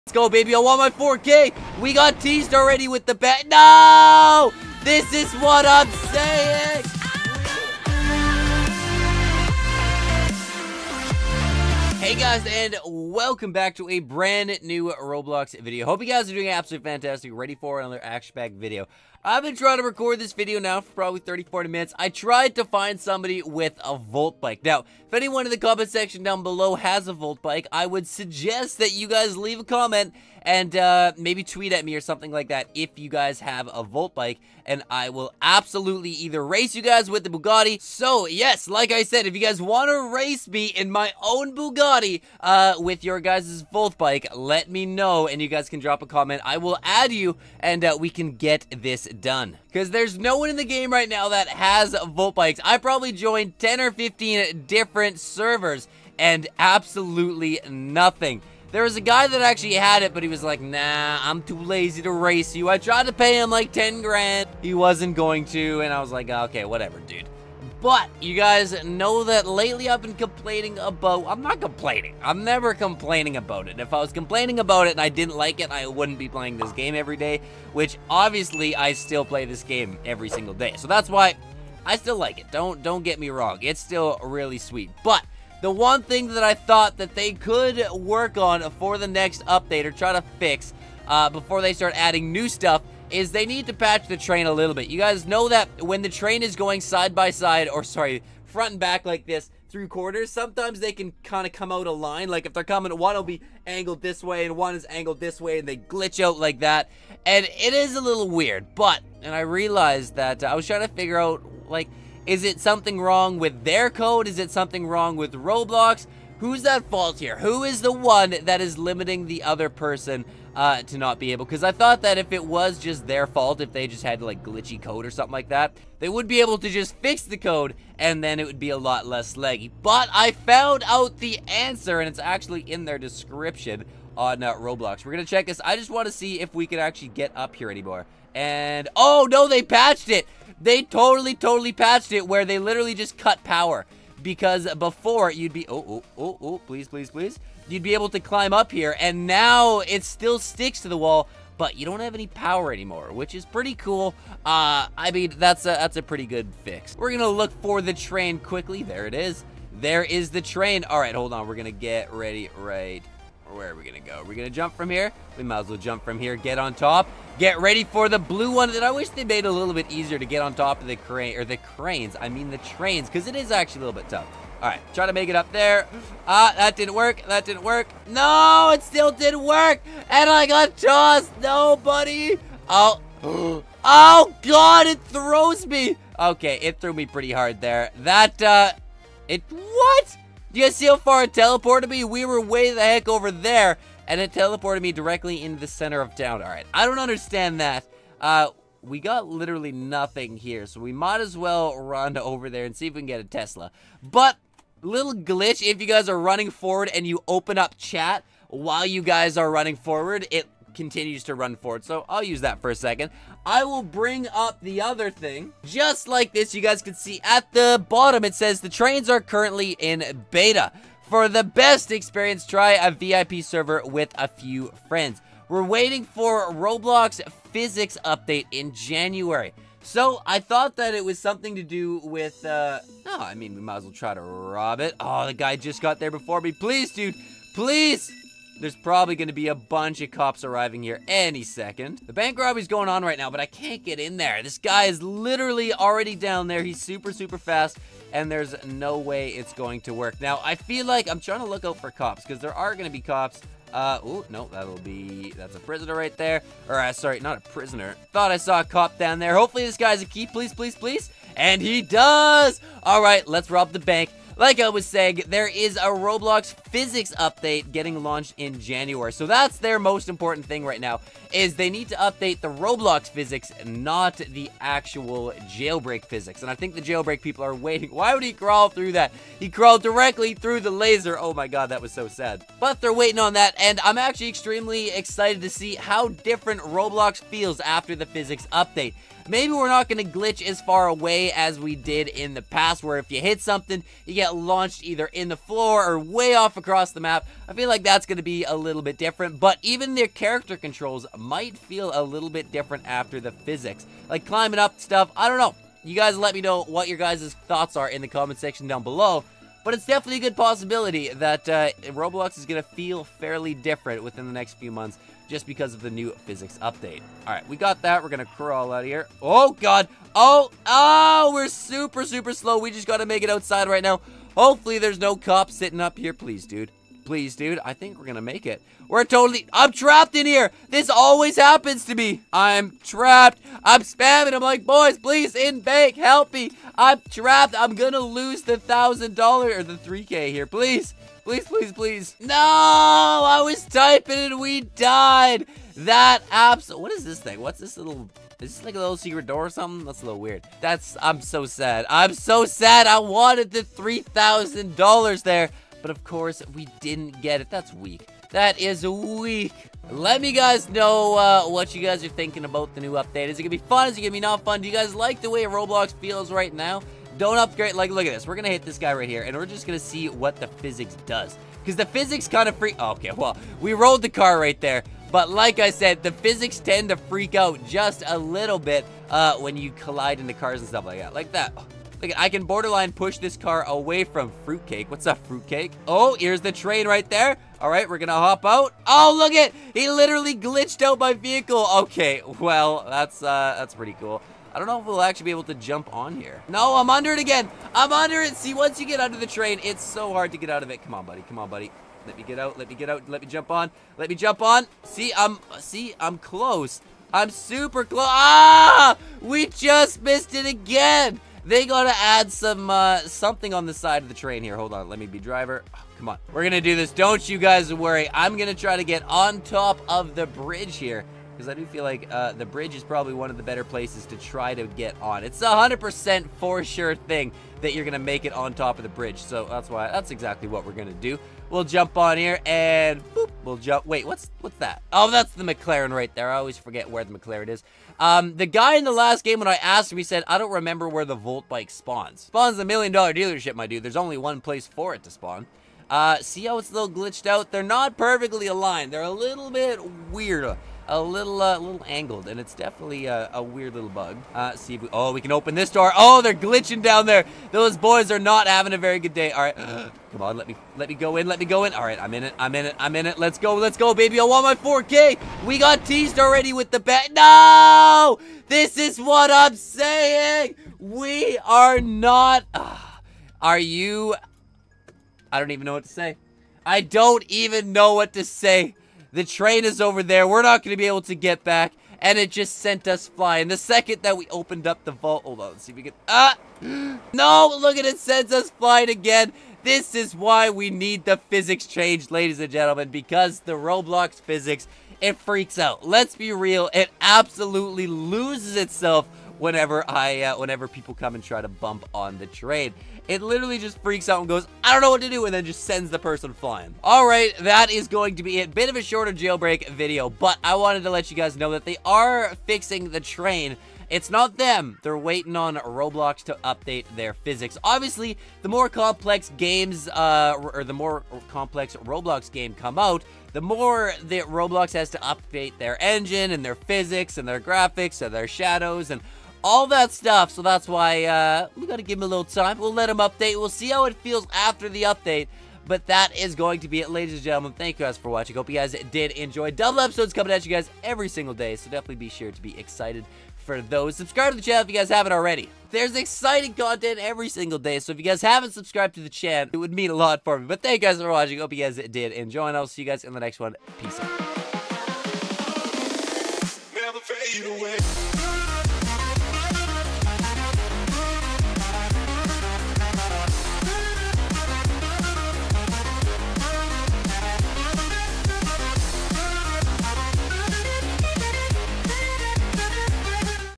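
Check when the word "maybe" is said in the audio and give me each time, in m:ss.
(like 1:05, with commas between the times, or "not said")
0:31, 4:49.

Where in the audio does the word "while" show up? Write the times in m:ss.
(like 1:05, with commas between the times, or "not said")
3:28.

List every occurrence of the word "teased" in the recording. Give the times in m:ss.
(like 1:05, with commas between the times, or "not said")
0:02, 7:45.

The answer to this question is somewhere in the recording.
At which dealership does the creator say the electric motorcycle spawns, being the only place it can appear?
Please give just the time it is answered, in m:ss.
7:22.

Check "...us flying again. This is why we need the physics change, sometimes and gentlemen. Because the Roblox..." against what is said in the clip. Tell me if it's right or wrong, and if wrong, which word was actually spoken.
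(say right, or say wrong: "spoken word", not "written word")
wrong: "ladies", not "sometimes".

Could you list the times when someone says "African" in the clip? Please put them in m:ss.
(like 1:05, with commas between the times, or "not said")
not said.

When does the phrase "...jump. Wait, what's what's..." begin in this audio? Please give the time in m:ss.
7:13.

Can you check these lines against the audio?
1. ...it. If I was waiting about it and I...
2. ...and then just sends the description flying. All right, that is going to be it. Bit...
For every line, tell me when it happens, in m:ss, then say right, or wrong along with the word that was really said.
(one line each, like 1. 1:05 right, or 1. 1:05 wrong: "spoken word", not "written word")
1. 1:13 wrong: "complaining", not "waiting"
2. 8:25 wrong: "person", not "description".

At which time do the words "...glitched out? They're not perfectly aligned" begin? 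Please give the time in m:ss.
7:26.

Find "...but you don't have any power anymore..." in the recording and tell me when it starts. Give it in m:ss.
2:31.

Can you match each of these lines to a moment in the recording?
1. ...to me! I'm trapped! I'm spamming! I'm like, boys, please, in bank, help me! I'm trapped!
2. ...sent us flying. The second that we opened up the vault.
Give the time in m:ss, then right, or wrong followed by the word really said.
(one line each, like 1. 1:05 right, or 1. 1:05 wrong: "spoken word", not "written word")
1. 5:31 right
2. 8:02 right.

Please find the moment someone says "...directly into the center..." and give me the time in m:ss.
3:14.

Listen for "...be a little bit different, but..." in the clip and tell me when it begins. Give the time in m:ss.
4:58.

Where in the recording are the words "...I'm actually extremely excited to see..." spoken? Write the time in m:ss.
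4:43.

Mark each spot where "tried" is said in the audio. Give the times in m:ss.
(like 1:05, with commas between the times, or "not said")
0:22, 1:02.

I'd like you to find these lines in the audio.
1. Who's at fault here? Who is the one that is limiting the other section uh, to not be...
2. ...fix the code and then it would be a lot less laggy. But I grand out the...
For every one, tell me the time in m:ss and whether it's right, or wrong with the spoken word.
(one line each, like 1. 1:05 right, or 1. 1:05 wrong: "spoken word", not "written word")
1. 1:56 wrong: "person", not "section"
2. 2:06 wrong: "found", not "grand".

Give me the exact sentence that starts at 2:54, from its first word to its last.
All right, try to make it up there.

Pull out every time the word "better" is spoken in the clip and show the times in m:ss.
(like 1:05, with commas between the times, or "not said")
7:03.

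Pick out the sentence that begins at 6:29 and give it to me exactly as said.
He literally glitched out my vehicle.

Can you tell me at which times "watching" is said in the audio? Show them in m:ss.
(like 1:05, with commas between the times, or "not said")
8:58, 9:11.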